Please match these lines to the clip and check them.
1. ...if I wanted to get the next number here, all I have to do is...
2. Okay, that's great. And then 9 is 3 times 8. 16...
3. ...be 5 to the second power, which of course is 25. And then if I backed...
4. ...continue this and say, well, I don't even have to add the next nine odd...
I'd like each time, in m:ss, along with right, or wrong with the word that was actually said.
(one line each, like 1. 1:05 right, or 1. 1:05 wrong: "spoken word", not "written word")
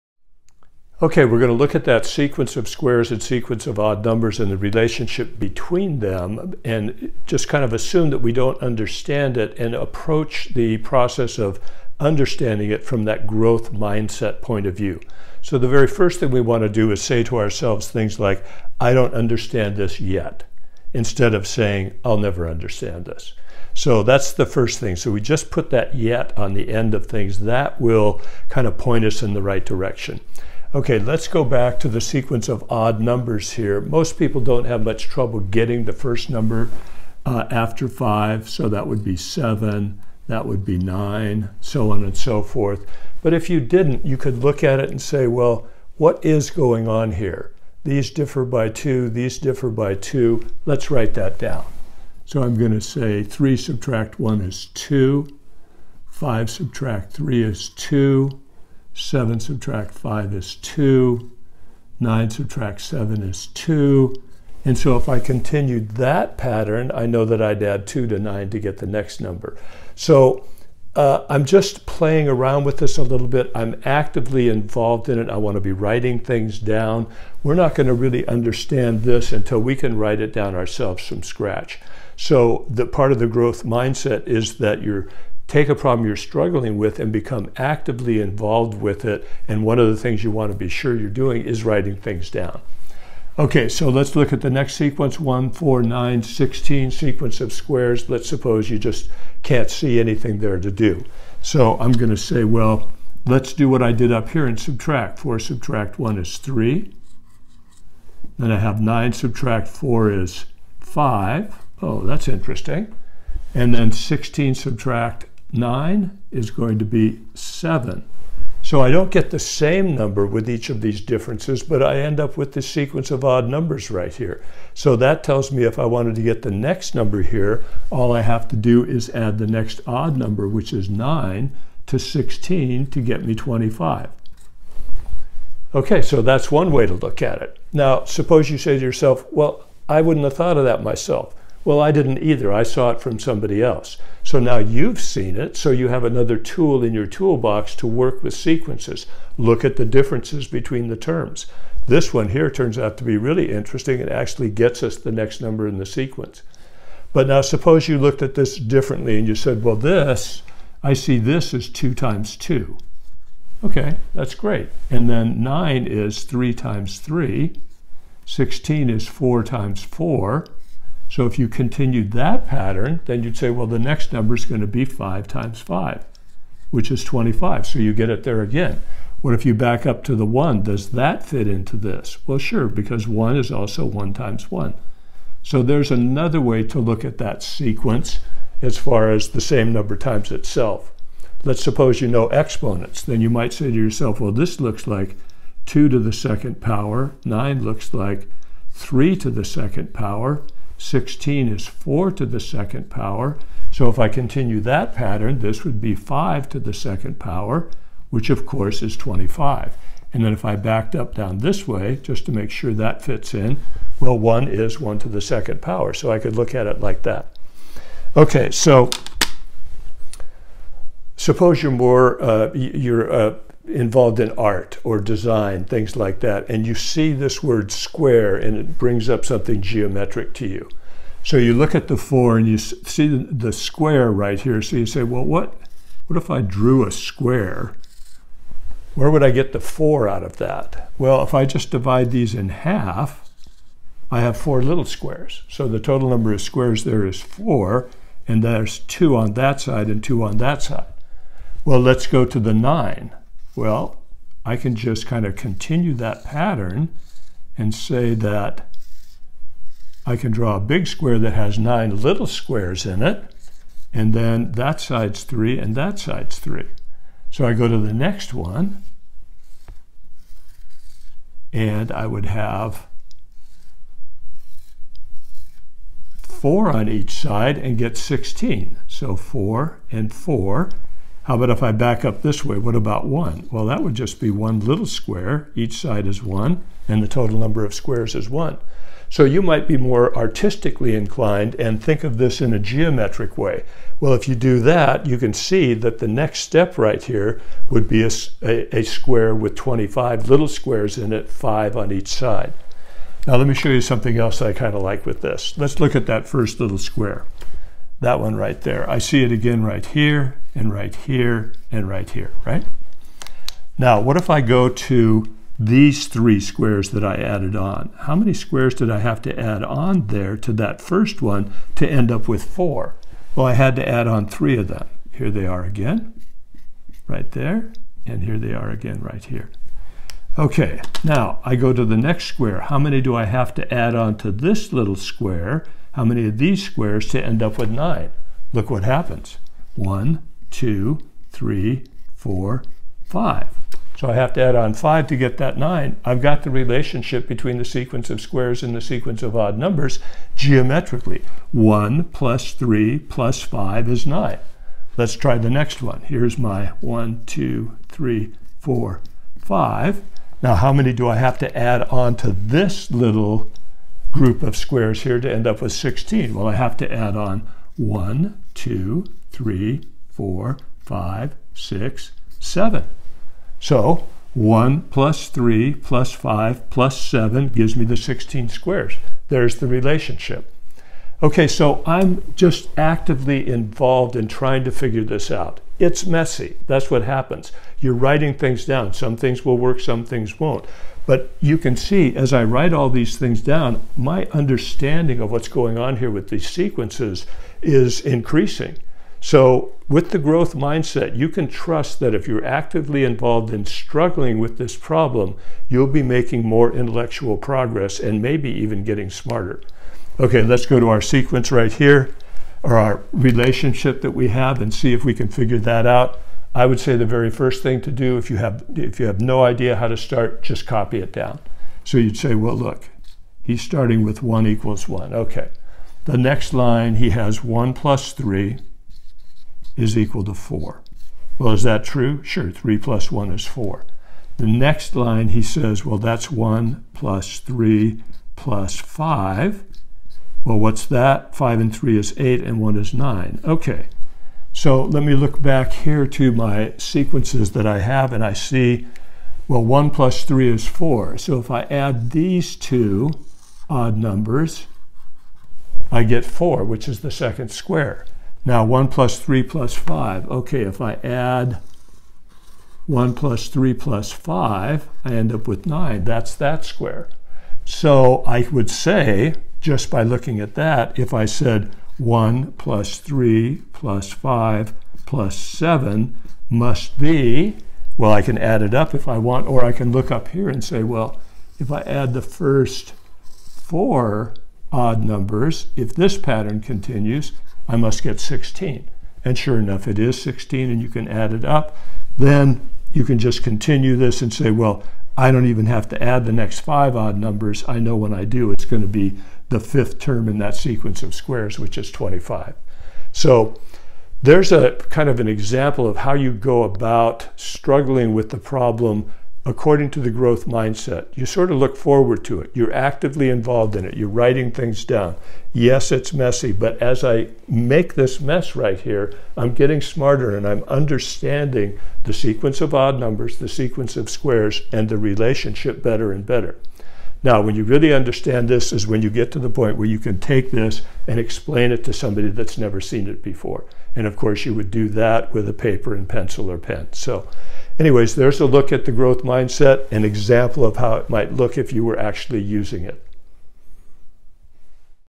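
1. 2:05 right
2. 2:43 wrong: "3", not "8"
3. 3:25 right
4. 8:13 wrong: "five", not "nine".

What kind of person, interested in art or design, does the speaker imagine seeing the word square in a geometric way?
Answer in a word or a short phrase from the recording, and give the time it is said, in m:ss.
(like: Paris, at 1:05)
artistically inclined, at 4:50.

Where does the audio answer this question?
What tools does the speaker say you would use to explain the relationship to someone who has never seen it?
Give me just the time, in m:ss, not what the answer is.
8:55.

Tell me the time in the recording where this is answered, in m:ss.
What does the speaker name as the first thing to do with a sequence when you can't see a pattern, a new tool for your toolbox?
2:29.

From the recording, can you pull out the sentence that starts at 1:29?
And one of the things you want to be sure you're doing is writing things down.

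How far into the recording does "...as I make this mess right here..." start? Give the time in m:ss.
8:36.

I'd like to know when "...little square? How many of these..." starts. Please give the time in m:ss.
5:34.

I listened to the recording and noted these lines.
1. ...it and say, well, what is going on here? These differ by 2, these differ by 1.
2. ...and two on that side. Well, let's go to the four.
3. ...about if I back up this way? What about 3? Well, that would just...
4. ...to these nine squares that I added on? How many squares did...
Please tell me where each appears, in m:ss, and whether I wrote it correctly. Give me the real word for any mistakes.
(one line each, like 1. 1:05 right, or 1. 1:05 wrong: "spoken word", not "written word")
1. 0:44 wrong: "2", not "1"
2. 4:09 wrong: "nine", not "four"
3. 4:41 wrong: "1", not "3"
4. 5:14 wrong: "three", not "nine".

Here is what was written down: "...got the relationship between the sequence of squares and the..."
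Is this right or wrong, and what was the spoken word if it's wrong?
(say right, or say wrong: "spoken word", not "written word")
right.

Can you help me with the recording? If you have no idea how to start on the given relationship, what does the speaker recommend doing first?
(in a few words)
copy it down.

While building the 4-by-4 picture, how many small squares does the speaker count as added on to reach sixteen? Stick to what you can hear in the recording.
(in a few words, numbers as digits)
7.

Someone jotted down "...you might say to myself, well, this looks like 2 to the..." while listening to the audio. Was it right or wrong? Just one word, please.
wrong.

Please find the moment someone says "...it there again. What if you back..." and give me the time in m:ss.
2:58.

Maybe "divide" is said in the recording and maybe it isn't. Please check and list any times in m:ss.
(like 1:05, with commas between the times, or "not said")
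4:01.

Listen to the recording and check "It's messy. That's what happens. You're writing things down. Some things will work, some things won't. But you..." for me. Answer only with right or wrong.
right.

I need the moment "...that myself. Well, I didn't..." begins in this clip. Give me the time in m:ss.
2:20.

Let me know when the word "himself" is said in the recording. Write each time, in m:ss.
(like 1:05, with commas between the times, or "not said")
not said.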